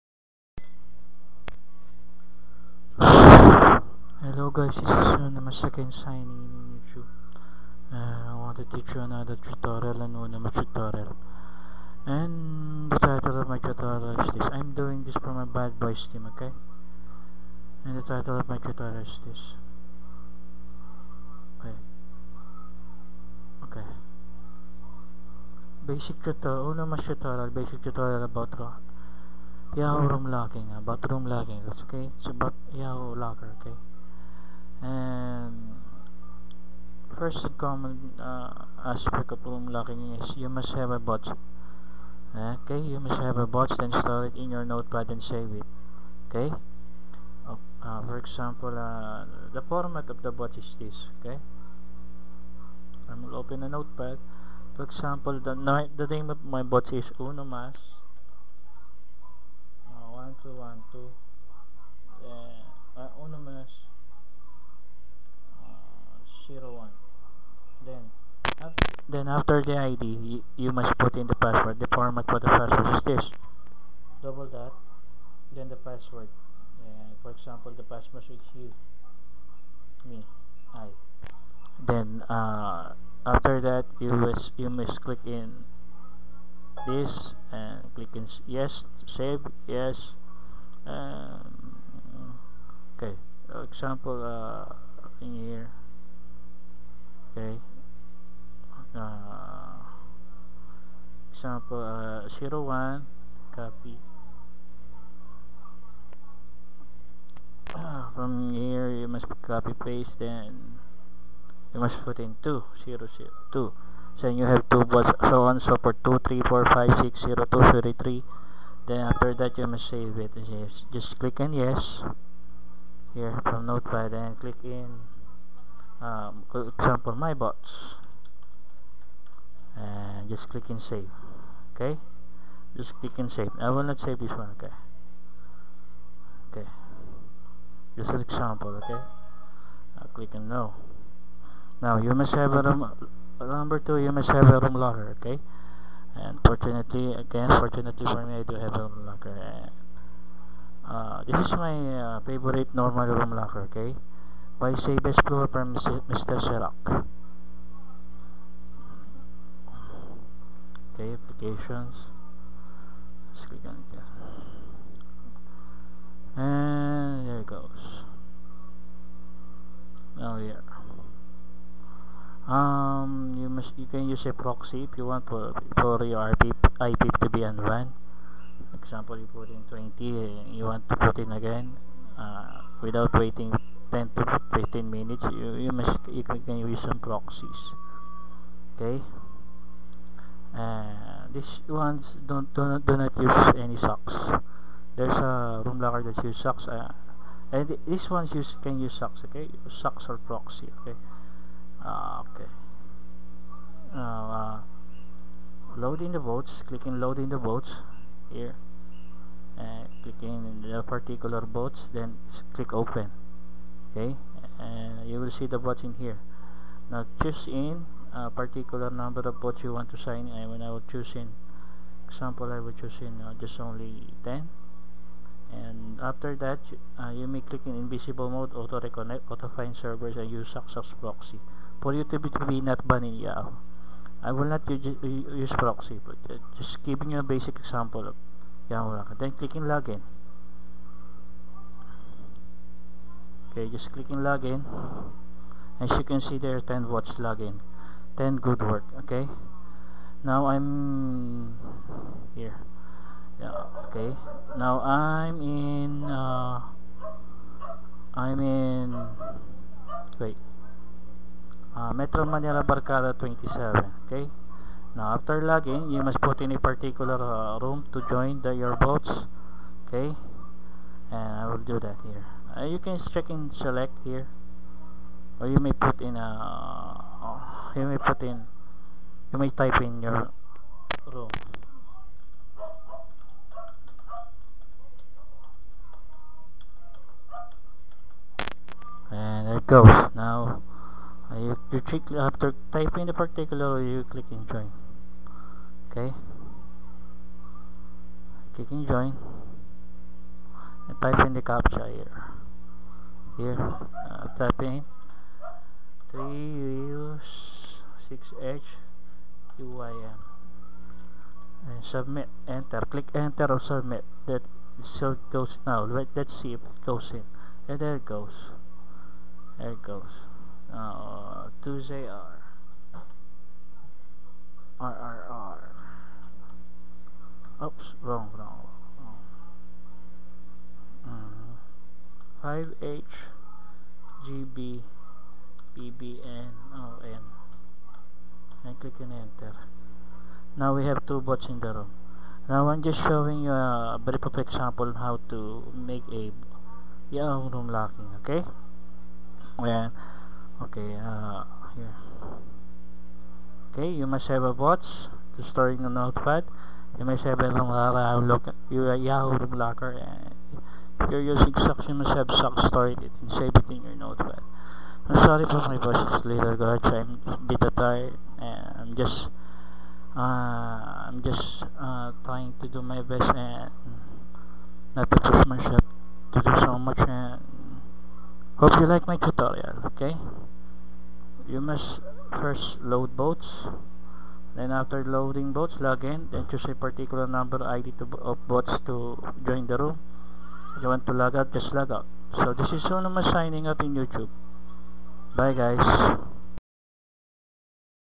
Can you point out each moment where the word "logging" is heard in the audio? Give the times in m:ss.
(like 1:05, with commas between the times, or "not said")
4:25.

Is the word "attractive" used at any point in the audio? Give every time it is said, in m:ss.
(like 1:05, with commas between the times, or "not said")
not said.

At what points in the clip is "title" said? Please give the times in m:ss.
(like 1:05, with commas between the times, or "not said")
0:12, 0:18.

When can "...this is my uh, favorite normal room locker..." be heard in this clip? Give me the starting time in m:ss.
2:31.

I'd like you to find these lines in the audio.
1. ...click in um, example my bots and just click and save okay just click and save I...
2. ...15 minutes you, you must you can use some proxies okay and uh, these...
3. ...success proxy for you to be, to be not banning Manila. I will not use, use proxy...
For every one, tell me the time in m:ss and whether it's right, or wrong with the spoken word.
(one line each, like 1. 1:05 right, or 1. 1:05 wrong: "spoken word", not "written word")
1. 2:04 right
2. 3:04 right
3. 3:50 wrong: "Yahoo", not "Manila".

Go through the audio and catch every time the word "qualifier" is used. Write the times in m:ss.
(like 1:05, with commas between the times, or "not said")
not said.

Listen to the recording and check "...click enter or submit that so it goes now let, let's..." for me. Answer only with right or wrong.
right.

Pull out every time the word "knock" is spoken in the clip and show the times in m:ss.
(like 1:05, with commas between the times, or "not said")
not said.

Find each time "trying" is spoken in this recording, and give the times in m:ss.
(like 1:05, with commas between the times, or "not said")
6:12.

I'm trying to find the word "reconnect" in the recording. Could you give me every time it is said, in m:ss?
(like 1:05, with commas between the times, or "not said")
3:48.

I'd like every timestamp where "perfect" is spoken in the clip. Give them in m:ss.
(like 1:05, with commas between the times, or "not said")
5:44.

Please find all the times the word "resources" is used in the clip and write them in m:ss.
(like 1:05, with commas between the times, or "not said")
not said.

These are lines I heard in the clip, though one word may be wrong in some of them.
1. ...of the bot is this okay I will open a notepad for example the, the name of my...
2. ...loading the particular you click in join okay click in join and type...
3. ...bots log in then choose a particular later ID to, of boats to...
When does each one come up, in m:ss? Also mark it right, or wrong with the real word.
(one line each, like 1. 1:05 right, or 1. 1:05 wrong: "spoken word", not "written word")
1. 0:50 right
2. 4:52 wrong: "typing", not "loading"
3. 6:25 wrong: "number", not "later".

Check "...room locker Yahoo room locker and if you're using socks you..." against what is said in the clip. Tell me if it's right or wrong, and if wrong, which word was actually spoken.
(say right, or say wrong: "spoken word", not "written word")
right.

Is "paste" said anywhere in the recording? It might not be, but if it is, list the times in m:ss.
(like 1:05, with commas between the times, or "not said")
1:49.